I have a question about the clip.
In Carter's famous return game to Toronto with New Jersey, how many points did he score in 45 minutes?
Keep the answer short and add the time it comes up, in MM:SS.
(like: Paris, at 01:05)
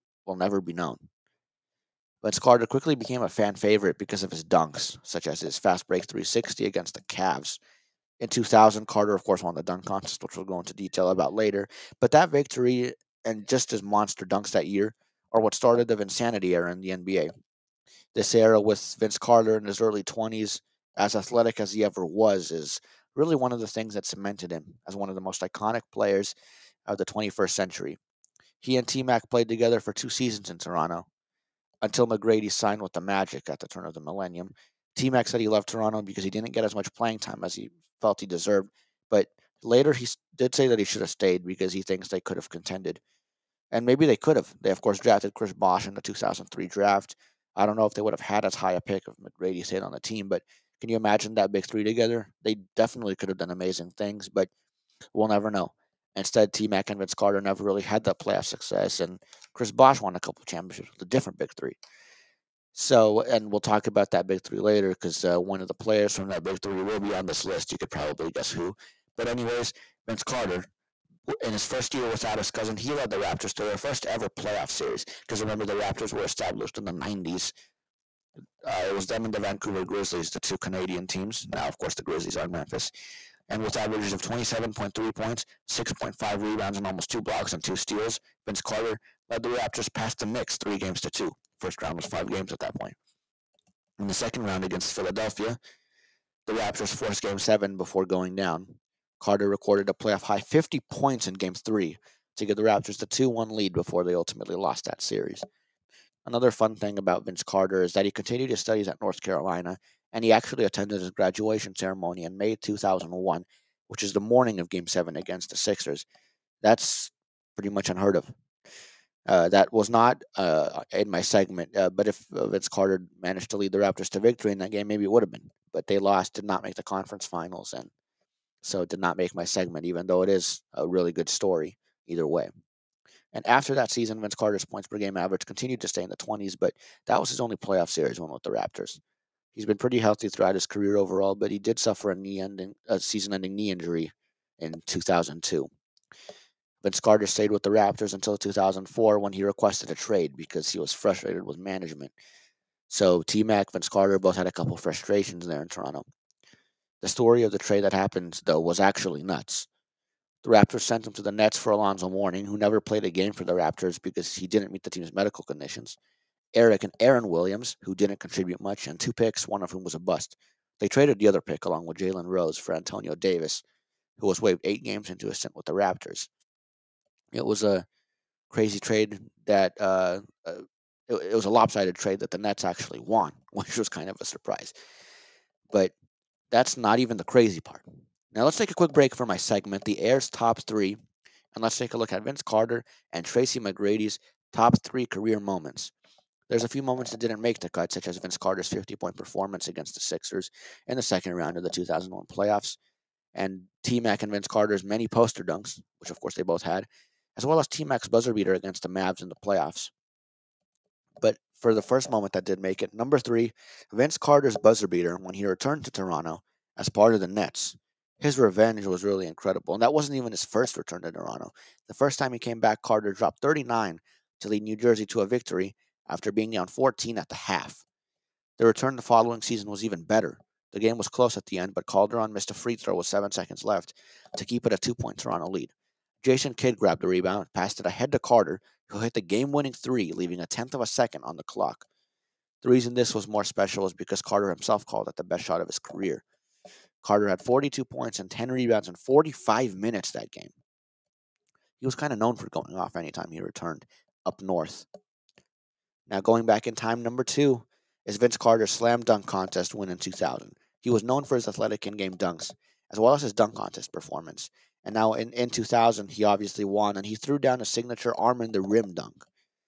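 42, at 04:07.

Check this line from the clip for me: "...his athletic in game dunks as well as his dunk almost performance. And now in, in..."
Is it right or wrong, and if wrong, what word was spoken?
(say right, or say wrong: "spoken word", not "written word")
wrong: "contest", not "almost".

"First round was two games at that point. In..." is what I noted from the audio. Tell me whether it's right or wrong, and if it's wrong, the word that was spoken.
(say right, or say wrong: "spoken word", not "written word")
wrong: "five", not "two".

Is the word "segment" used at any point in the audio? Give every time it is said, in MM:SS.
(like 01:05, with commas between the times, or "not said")
02:01, 02:09, 03:09.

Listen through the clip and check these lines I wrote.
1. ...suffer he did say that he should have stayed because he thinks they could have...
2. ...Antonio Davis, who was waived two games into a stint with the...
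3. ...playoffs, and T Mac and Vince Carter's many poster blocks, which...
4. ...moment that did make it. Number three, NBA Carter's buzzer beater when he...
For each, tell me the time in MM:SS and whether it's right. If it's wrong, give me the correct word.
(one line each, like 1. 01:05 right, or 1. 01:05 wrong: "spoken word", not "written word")
1. 00:39 wrong: "later", not "suffer"
2. 02:52 wrong: "eight", not "two"
3. 03:22 wrong: "dunks", not "blocks"
4. 03:32 wrong: "Vince", not "NBA".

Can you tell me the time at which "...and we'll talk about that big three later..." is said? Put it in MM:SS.
01:03.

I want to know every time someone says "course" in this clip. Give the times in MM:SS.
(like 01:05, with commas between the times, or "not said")
00:09, 00:44, 01:21, 03:26.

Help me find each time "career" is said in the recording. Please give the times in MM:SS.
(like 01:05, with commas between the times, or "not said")
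02:20, 03:15, 04:05.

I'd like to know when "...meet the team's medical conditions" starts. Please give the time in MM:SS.
02:44.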